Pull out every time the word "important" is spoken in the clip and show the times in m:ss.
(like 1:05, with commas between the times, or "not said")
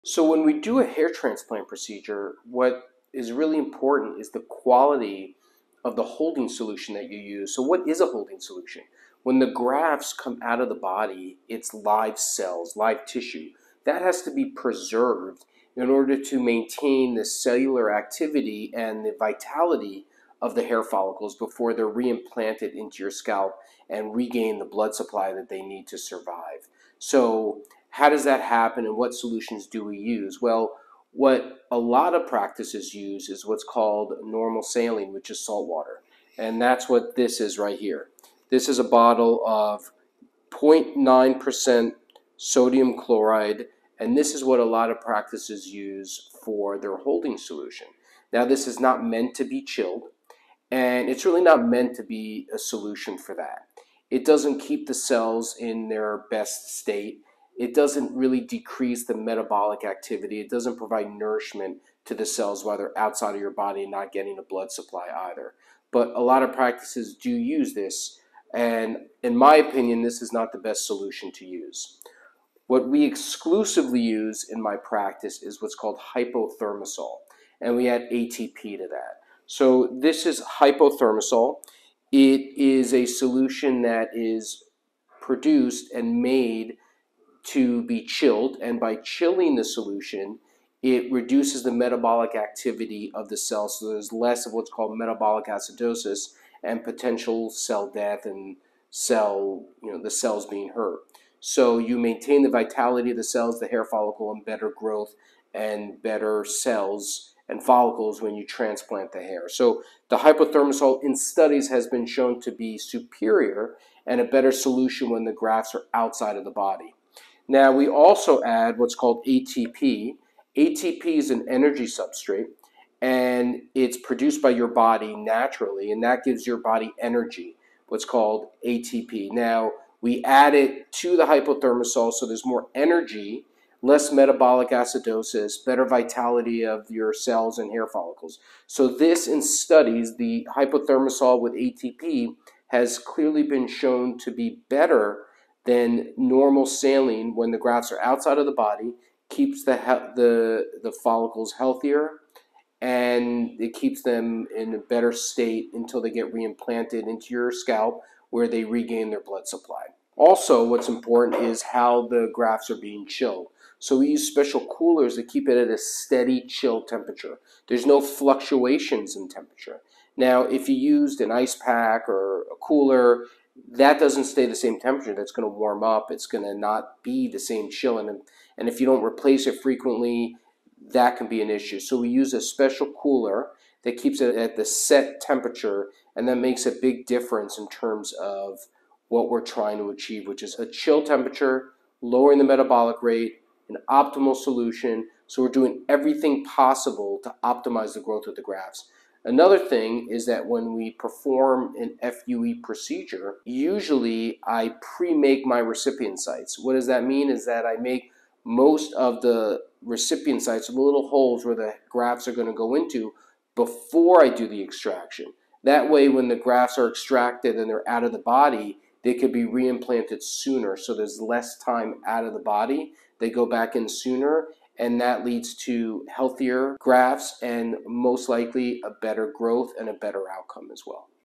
0:03, 2:40.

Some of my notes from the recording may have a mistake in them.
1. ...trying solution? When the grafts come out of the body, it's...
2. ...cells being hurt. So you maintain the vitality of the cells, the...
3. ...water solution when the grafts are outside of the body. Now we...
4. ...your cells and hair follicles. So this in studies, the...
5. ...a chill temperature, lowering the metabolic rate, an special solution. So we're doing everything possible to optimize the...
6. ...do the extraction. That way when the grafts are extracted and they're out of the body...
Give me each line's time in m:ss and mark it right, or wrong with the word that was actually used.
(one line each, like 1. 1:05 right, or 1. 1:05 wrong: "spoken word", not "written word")
1. 0:08 wrong: "holding", not "trying"
2. 1:40 right
3. 1:54 wrong: "better", not "water"
4. 2:16 right
5. 3:10 wrong: "optimal", not "special"
6. 3:34 right.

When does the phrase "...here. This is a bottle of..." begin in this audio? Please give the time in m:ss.
0:37.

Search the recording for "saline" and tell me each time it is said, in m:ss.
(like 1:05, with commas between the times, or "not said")
0:34, 2:26.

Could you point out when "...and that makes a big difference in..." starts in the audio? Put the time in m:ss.
3:06.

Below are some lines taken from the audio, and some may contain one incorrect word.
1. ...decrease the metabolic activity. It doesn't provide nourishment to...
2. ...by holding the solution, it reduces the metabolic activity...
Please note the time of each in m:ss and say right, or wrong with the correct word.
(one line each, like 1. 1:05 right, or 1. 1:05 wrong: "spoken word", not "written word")
1. 0:58 right
2. 1:28 wrong: "chilling", not "holding".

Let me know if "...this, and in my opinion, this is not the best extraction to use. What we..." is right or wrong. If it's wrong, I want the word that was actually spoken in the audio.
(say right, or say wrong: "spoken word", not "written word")
wrong: "solution", not "extraction".